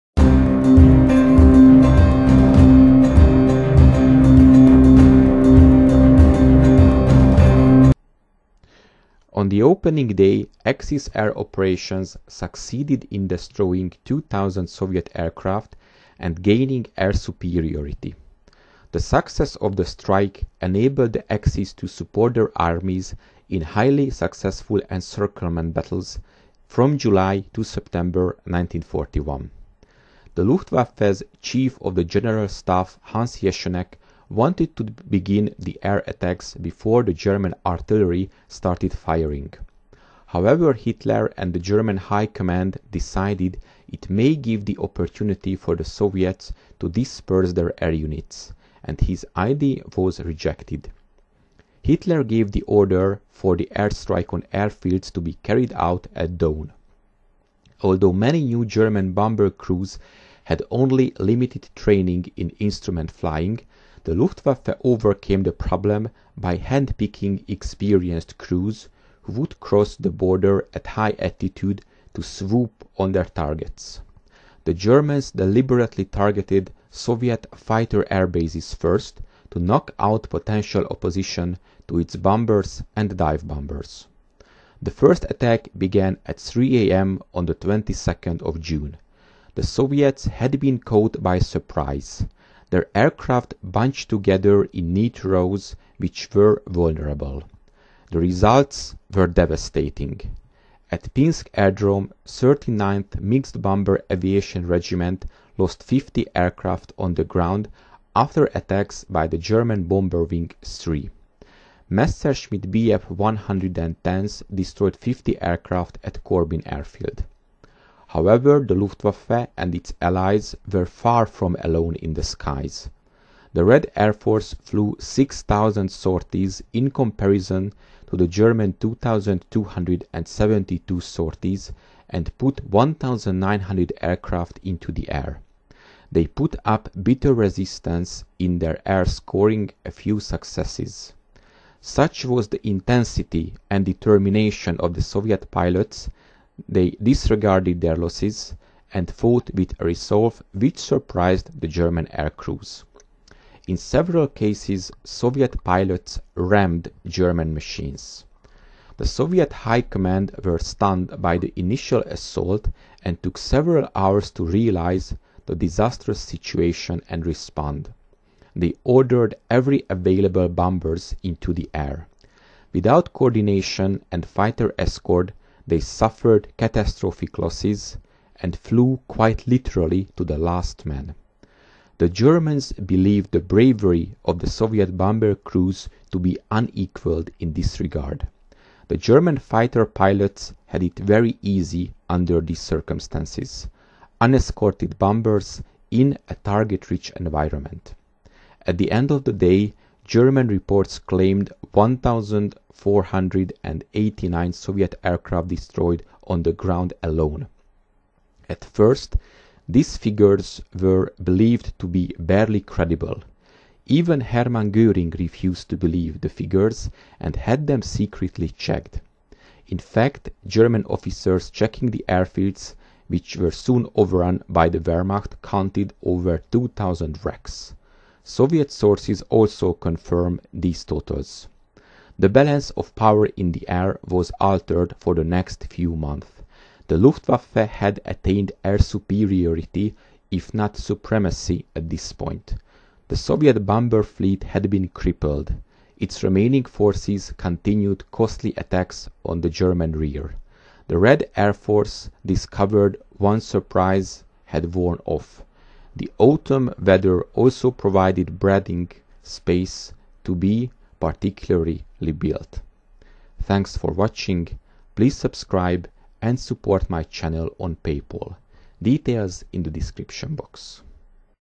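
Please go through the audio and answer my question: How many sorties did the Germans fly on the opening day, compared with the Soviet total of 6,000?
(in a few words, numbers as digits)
2,272.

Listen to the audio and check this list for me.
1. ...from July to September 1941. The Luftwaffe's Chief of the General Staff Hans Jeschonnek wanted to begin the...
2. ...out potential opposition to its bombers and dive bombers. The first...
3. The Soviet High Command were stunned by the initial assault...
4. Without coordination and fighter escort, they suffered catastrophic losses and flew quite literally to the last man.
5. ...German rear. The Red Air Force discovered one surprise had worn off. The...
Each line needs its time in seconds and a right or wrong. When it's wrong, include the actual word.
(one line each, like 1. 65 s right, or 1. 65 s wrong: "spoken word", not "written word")
1. 26 s right
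2. 79 s right
3. 158 s right
4. 172 s right
5. 249 s right.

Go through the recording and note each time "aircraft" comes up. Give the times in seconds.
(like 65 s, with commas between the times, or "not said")
15 s, 92 s, 106 s, 115 s, 134 s, 205 s.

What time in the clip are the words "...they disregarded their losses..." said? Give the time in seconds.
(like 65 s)
146 s.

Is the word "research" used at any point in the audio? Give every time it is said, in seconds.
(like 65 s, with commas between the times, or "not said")
not said.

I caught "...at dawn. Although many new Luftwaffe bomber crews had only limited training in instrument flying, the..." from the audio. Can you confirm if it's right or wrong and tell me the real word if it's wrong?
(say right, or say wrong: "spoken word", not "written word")
wrong: "German", not "Luftwaffe".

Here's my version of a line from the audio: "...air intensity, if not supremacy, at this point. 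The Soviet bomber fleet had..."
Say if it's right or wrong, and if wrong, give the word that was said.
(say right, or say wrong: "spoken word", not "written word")
wrong: "superiority", not "intensity".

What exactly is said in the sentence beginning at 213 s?
Even Hermann Göring refused to believe the figures and had them secretly checked.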